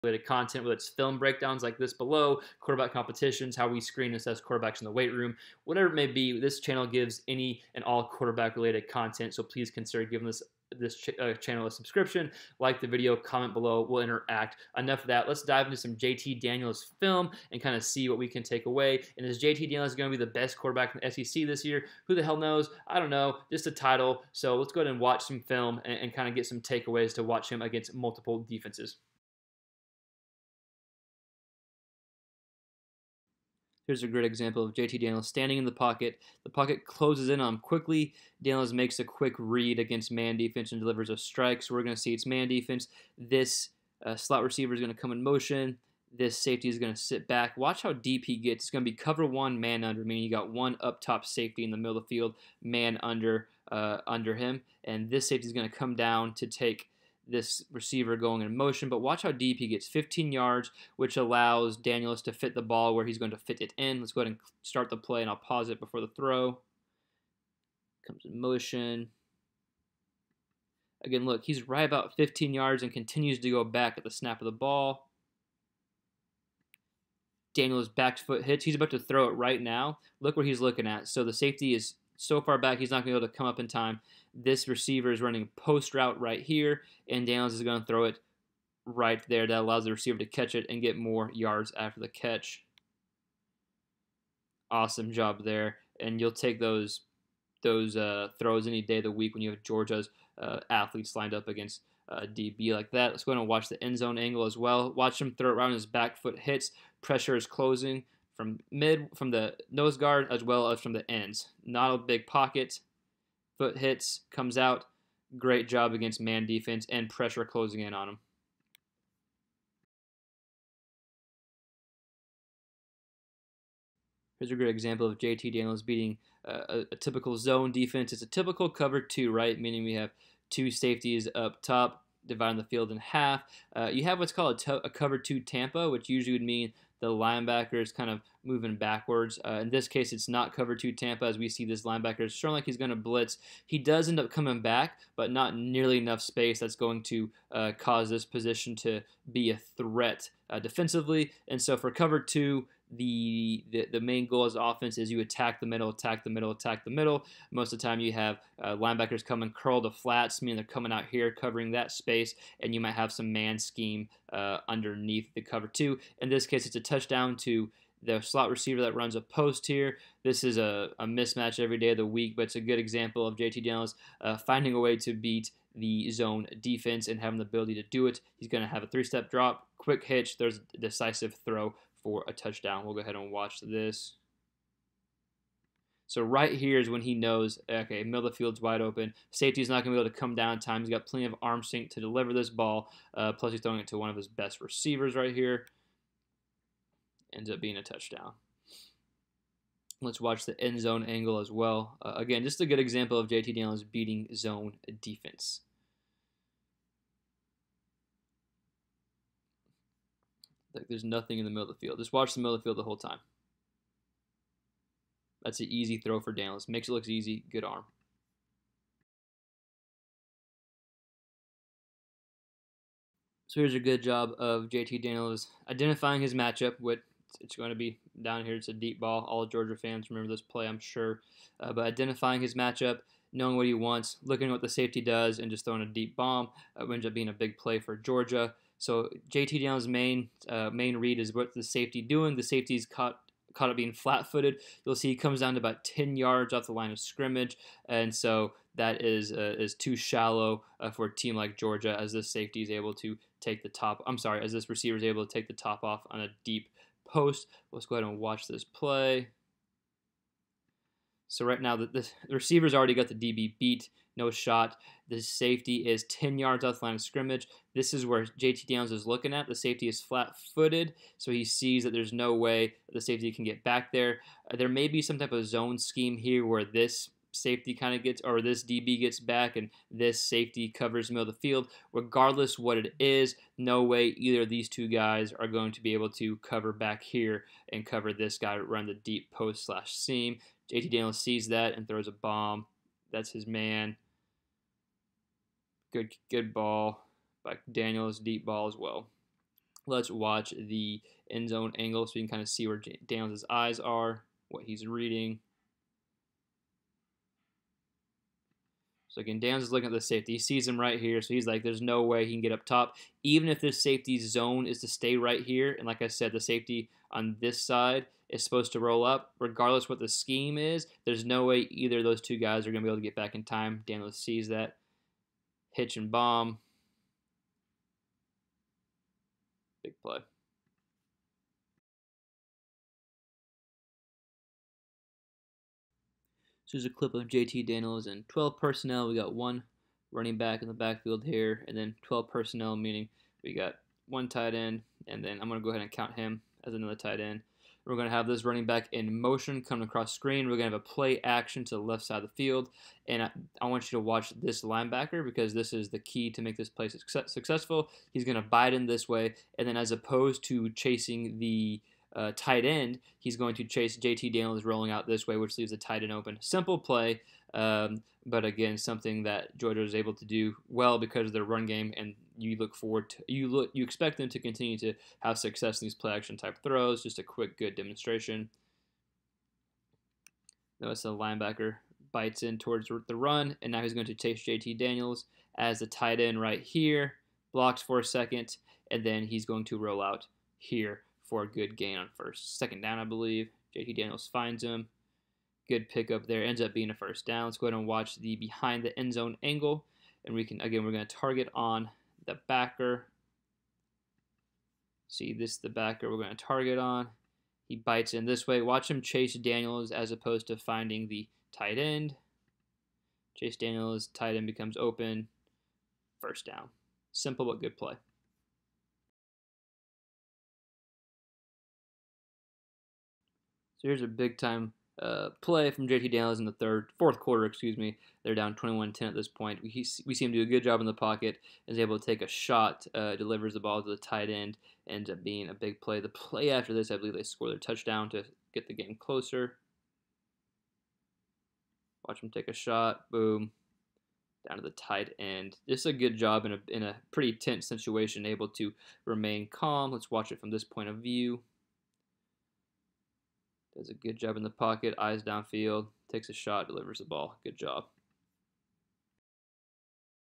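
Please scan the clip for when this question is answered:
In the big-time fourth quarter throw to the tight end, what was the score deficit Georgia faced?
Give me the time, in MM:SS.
07:08.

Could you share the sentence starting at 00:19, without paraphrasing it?
And is JT Daniels going to be the best quarterback in the SEC this year?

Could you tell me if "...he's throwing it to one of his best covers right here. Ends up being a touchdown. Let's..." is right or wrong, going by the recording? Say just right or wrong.
wrong.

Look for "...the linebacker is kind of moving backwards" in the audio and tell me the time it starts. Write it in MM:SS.
02:17.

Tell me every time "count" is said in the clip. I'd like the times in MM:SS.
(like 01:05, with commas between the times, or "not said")
05:45.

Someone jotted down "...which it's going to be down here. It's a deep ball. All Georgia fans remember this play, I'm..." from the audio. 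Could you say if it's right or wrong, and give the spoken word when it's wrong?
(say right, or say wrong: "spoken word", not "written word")
right.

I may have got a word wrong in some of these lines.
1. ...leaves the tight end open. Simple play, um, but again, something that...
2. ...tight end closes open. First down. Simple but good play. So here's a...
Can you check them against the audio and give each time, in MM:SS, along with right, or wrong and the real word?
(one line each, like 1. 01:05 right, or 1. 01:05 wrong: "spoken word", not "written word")
1. 06:05 right
2. 06:54 wrong: "becomes", not "closes".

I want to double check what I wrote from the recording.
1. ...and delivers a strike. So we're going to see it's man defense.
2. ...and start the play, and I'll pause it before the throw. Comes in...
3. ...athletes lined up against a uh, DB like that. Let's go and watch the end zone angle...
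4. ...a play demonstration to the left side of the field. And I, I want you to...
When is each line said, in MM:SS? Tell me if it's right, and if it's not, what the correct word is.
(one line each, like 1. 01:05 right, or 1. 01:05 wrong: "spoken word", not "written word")
1. 00:40 right
2. 01:04 right
3. 01:40 right
4. 05:50 wrong: "action", not "demonstration".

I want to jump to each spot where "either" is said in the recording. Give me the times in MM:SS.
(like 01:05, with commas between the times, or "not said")
04:44, 05:21.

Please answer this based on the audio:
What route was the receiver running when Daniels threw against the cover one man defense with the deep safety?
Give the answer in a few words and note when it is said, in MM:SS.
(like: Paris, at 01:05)
post route, at 01:25.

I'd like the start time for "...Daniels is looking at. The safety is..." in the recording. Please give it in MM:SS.
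04:28.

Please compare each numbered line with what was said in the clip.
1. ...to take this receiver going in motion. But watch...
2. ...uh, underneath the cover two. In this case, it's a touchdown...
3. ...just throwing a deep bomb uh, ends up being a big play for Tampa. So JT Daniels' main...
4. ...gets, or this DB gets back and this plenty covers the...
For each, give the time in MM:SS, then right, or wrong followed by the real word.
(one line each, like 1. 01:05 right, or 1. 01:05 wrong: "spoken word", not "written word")
1. 00:56 right
2. 02:44 right
3. 03:55 wrong: "Georgia", not "Tampa"
4. 04:38 wrong: "safety", not "plenty".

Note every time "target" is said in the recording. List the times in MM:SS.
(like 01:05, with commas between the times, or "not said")
06:41, 06:46.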